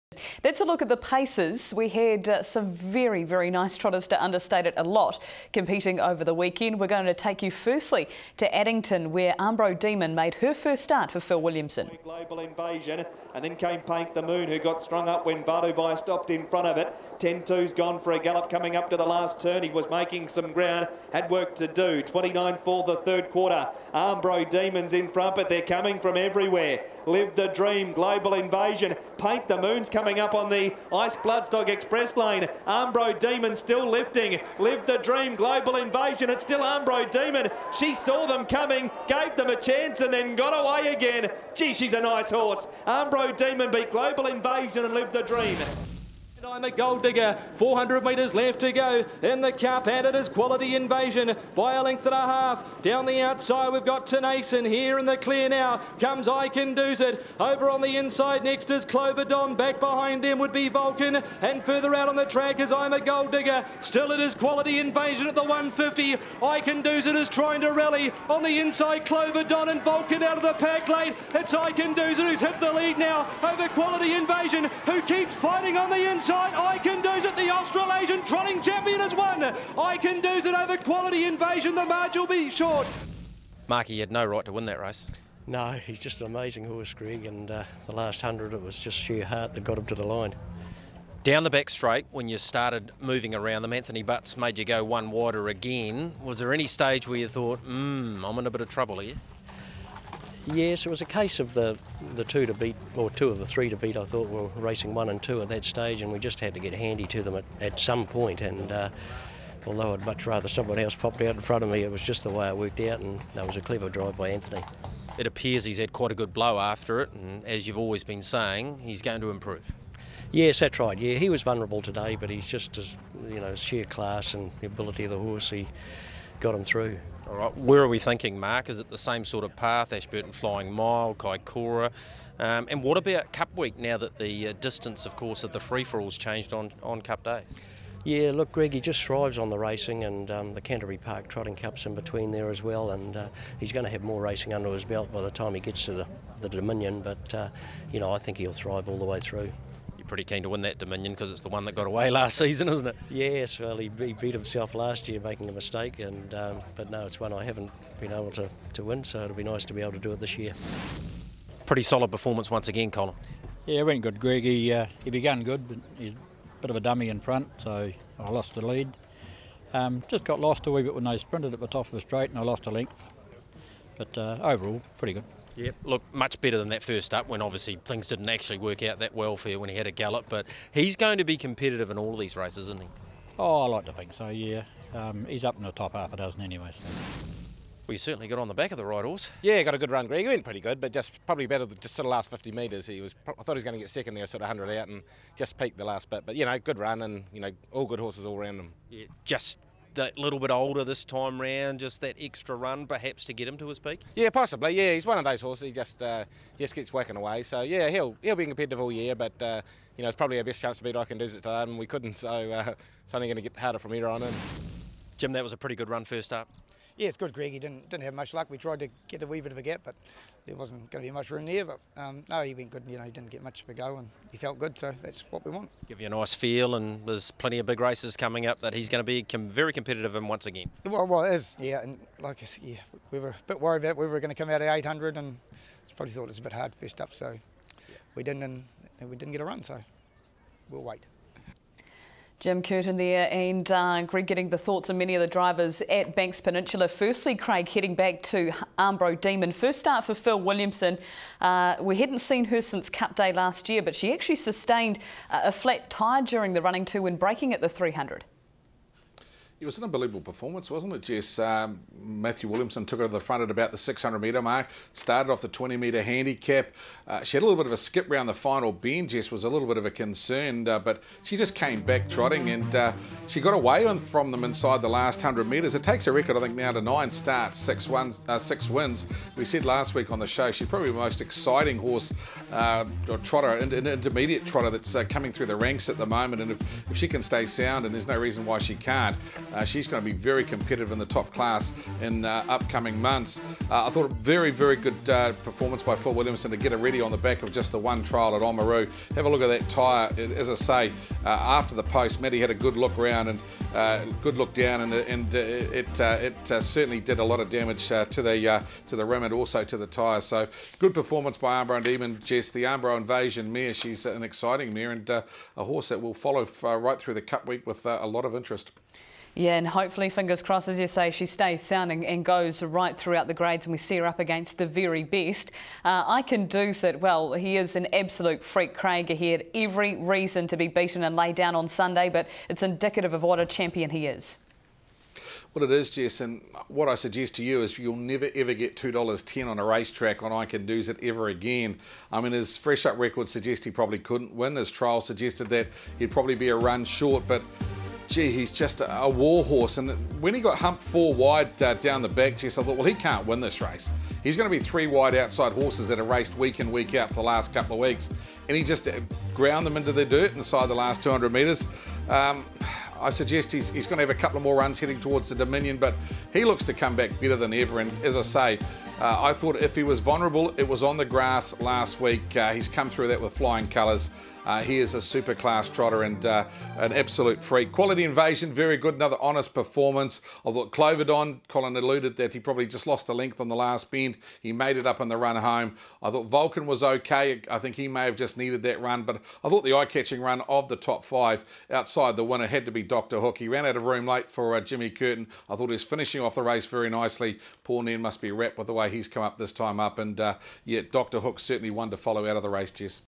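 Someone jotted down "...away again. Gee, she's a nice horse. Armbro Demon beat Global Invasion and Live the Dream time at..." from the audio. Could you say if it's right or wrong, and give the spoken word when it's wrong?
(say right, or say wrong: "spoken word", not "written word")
right.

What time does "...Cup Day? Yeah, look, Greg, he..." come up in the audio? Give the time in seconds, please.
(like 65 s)
137 s.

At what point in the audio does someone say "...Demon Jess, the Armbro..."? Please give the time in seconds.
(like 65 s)
311 s.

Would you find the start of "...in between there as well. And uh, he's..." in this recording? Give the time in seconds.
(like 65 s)
141 s.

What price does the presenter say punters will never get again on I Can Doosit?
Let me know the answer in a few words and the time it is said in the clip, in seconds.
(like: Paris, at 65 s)
$2.10, at 338 s.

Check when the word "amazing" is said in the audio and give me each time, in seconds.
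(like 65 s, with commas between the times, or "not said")
86 s.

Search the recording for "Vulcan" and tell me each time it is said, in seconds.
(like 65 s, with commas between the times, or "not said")
60 s, 69 s, 386 s.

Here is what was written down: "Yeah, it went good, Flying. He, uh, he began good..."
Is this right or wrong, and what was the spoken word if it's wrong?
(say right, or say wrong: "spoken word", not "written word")
wrong: "Greg", not "Flying".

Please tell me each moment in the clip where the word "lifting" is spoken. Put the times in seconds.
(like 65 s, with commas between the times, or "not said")
33 s.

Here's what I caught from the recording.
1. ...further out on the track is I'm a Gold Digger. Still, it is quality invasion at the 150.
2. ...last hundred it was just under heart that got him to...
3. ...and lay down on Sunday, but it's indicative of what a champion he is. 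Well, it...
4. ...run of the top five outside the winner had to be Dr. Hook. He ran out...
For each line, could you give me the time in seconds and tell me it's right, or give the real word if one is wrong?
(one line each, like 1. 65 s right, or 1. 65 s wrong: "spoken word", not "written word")
1. 61 s right
2. 87 s wrong: "sheer", not "under"
3. 331 s right
4. 390 s right.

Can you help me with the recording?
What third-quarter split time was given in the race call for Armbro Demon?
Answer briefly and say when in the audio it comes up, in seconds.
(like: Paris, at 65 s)
29, at 22 s.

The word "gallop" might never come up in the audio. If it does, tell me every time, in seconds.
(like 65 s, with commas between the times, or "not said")
18 s, 179 s.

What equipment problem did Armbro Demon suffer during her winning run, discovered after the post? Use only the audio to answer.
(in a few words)
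flat tyre.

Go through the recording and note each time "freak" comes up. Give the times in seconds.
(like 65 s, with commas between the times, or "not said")
328 s, 377 s.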